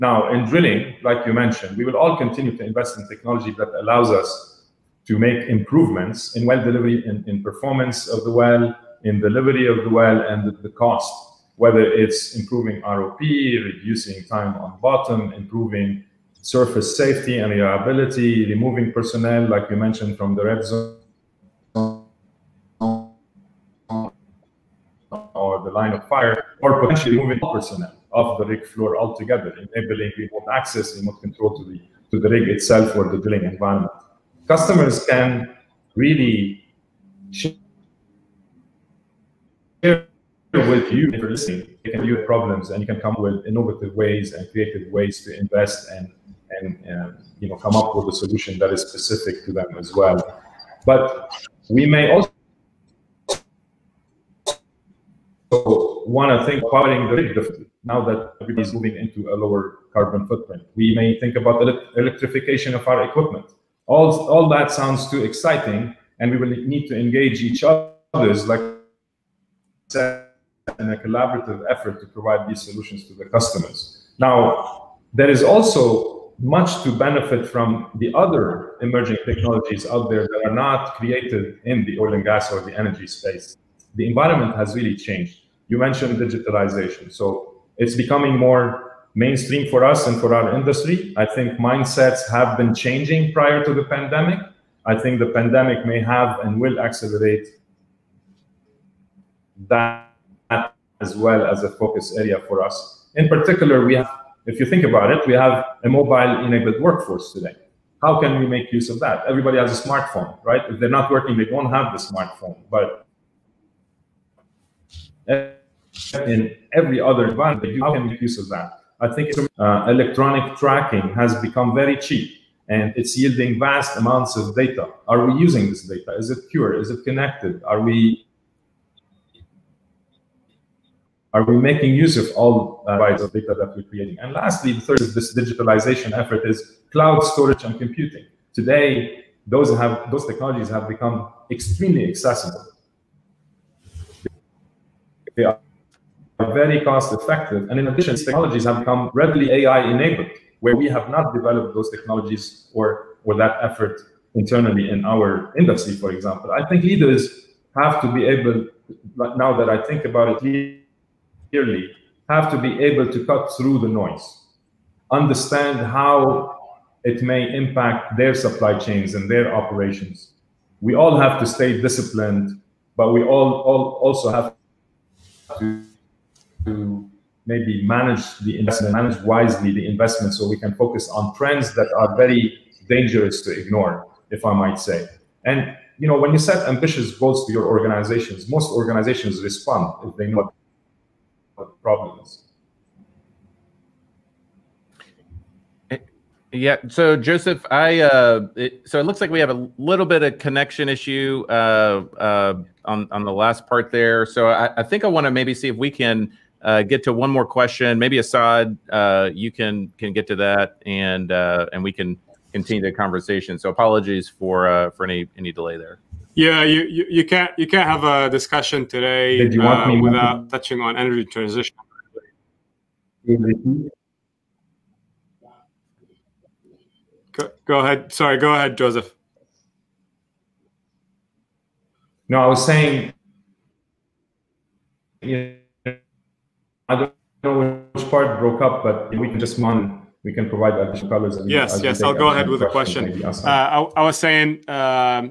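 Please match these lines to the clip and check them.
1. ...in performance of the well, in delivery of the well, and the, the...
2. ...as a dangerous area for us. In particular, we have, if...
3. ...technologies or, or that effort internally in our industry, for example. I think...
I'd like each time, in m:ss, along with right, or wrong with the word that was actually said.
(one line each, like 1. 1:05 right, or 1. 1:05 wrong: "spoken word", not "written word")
1. 0:07 right
2. 1:41 wrong: "focus", not "dangerous"
3. 2:31 right.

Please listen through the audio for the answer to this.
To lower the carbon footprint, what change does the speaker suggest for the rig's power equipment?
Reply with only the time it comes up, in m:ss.
1:01.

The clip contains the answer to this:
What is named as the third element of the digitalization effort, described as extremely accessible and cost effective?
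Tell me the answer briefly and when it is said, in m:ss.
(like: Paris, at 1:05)
cloud storage and computing, at 2:16.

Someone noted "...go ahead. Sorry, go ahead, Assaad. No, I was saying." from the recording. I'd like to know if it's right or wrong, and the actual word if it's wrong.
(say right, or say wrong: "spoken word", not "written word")
wrong: "Joseph", not "Assaad".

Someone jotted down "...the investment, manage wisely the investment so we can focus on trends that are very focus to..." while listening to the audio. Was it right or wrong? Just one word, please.
wrong.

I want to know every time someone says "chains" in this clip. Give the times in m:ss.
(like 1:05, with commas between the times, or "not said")
2:48.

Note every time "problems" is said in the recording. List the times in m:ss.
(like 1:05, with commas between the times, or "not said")
0:42, 3:11.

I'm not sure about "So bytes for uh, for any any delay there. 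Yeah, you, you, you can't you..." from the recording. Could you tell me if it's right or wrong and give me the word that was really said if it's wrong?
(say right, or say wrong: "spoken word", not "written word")
wrong: "apologies", not "bytes".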